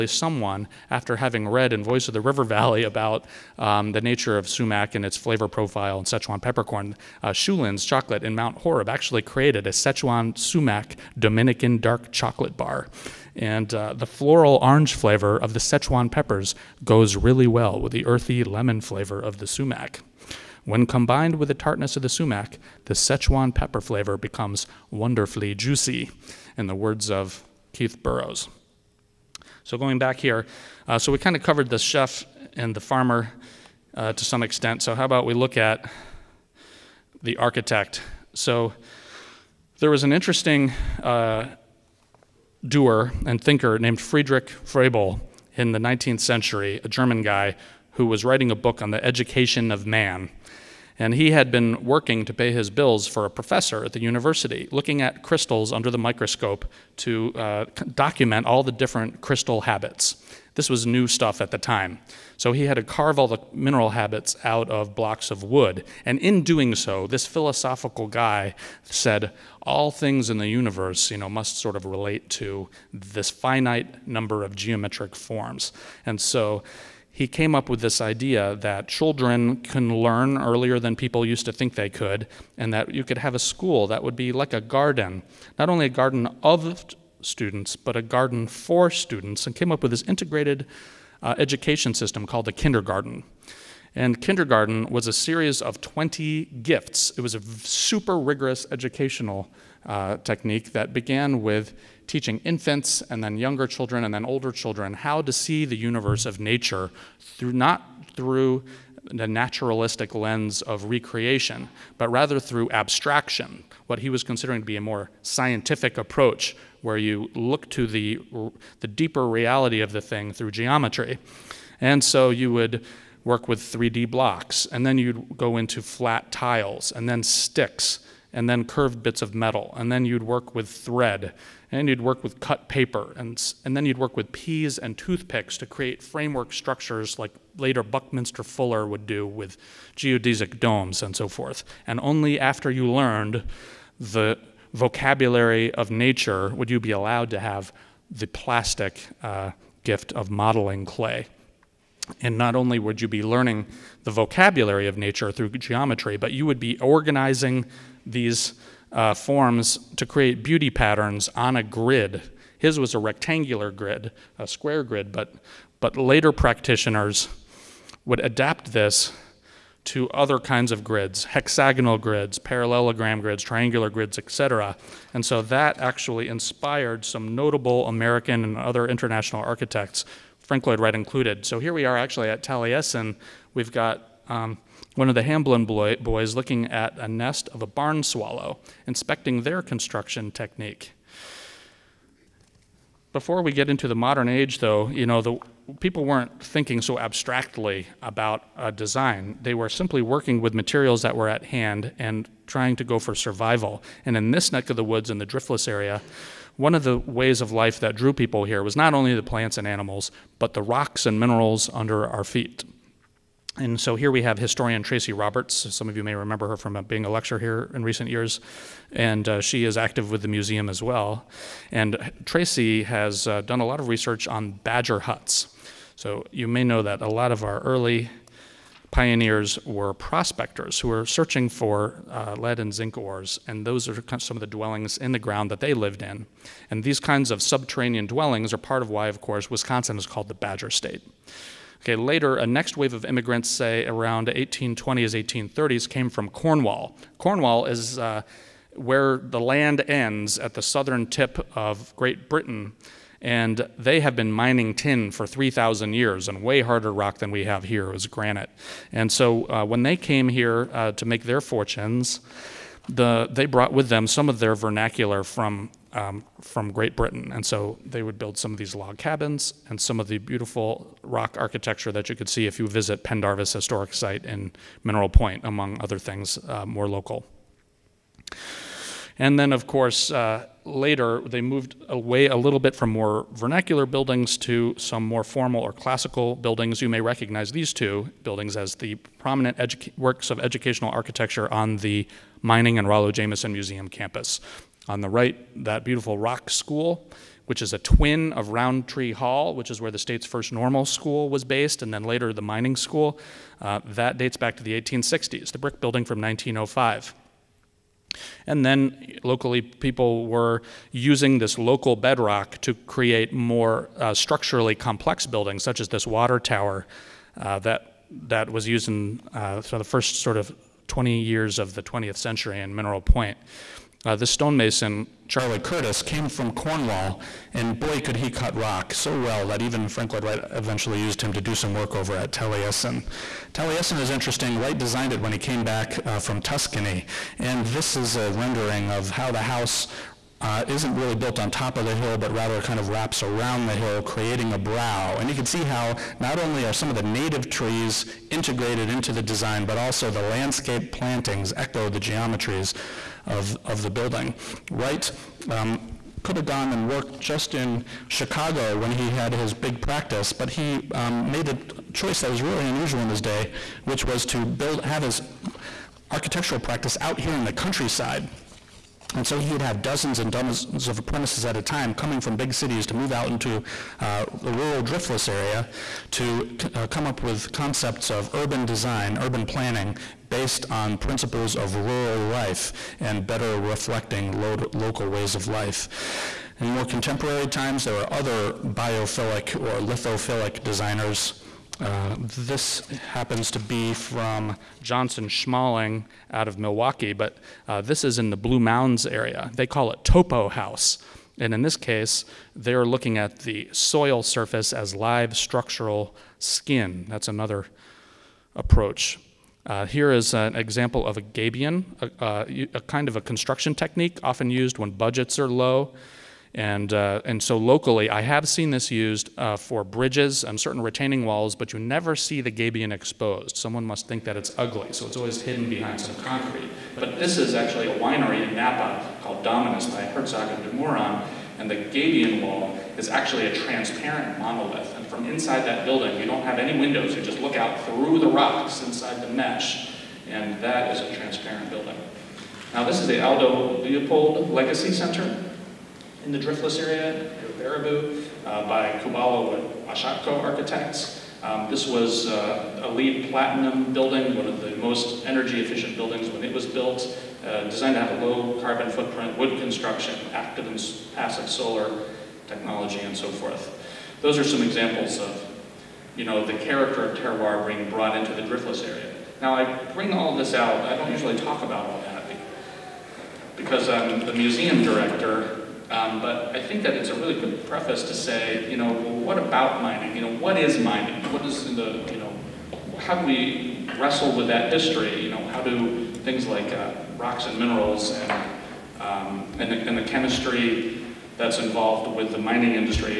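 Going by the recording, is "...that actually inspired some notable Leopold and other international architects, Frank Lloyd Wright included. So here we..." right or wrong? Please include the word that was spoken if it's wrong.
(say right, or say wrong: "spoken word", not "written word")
wrong: "American", not "Leopold".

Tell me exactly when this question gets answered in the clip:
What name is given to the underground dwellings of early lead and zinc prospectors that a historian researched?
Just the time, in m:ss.
3:44.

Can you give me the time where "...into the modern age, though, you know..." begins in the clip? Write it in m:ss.
3:13.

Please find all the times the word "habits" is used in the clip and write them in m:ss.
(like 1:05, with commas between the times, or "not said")
0:59, 1:03.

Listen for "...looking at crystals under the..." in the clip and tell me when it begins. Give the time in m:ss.
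0:54.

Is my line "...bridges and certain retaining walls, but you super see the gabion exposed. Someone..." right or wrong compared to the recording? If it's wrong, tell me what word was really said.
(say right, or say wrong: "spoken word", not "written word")
wrong: "never", not "super".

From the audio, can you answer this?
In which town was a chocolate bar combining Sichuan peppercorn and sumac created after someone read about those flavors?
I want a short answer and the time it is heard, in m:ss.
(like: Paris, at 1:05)
Mount Horeb, at 0:08.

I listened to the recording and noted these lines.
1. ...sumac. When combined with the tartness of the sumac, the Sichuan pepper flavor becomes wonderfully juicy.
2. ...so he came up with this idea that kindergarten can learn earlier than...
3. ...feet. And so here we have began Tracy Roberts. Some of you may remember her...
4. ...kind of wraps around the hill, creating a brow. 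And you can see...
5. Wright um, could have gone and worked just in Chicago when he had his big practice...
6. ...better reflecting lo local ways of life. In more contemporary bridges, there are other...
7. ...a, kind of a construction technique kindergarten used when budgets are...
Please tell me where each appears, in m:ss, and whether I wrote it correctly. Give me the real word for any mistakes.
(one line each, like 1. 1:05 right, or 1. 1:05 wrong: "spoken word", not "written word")
1. 0:19 right
2. 1:16 wrong: "children", not "kindergarten"
3. 3:32 wrong: "historian", not "began"
4. 5:42 right
5. 5:54 right
6. 6:23 wrong: "times", not "bridges"
7. 6:52 wrong: "often", not "kindergarten".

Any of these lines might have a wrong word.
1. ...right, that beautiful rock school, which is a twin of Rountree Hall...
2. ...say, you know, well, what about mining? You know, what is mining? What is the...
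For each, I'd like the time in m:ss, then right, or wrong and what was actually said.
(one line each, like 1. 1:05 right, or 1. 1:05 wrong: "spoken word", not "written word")
1. 4:55 right
2. 7:58 right.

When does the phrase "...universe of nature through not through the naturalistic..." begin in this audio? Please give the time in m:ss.
1:45.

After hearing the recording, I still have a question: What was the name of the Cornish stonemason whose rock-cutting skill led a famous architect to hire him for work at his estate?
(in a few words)
Charlie Curtis.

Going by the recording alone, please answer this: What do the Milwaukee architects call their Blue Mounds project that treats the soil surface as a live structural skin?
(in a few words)
Topo House.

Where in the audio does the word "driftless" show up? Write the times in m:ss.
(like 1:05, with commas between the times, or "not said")
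3:25, 6:14, 7:26, 7:48.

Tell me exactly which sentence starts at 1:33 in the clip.
And kindergarten was a series of 20 gifts.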